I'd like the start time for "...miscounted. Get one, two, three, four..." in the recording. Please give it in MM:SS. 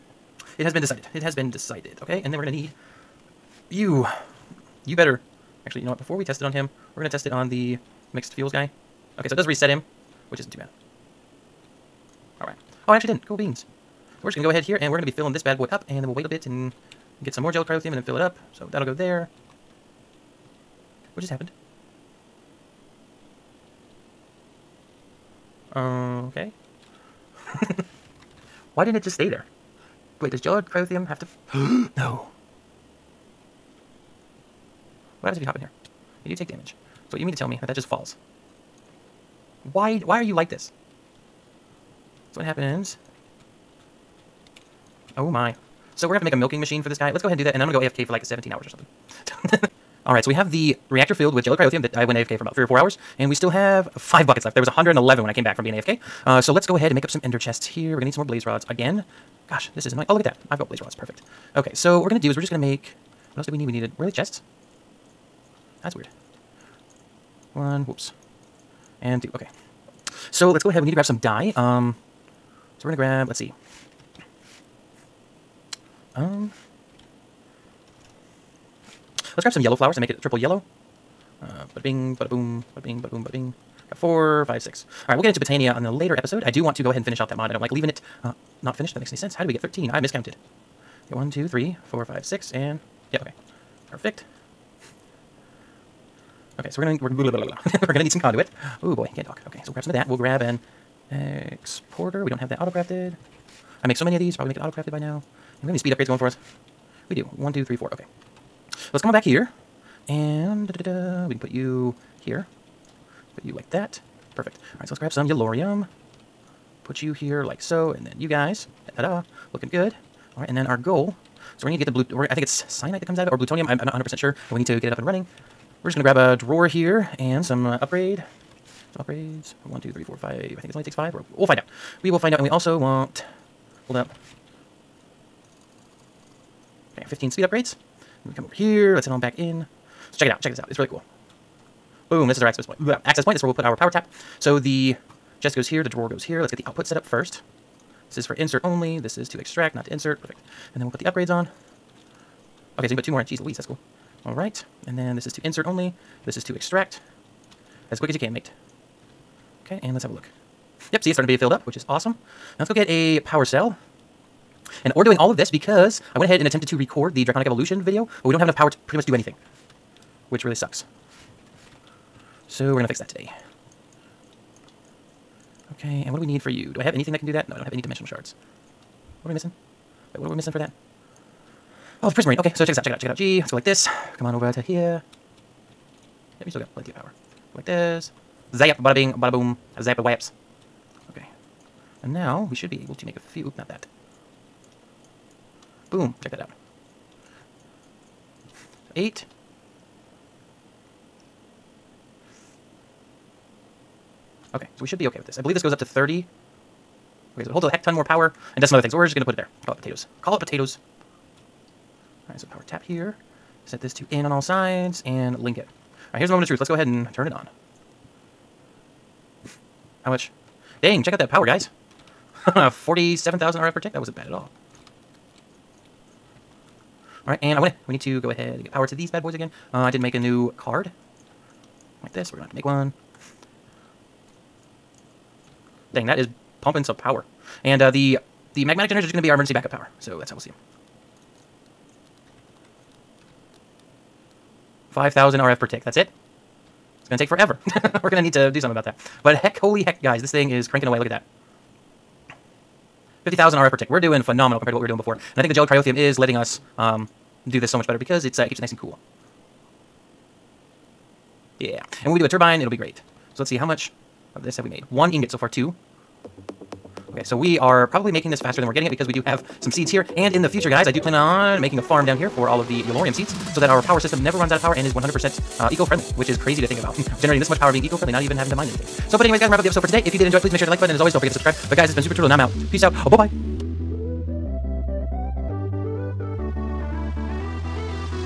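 01:29.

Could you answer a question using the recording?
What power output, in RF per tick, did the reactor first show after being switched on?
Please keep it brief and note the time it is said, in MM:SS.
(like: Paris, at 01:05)
47,000 RF per tick, at 03:42.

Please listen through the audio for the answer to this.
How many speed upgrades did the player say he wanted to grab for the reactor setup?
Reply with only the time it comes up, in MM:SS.
02:17.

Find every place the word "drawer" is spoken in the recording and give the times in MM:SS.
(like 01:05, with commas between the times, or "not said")
02:06, 02:25.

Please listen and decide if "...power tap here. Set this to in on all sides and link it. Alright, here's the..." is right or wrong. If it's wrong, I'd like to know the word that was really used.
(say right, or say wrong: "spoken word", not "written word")
right.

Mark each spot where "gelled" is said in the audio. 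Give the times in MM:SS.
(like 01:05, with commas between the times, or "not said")
00:17, 04:15.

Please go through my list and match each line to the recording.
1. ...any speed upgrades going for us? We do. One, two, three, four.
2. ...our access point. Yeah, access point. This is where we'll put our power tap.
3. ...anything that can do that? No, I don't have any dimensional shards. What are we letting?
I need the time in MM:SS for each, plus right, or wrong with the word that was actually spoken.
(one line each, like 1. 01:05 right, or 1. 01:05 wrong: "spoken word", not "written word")
1. 01:45 right
2. 02:22 right
3. 02:56 wrong: "missing", not "letting".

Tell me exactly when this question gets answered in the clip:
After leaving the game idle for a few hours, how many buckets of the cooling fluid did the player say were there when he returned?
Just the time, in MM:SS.
00:54.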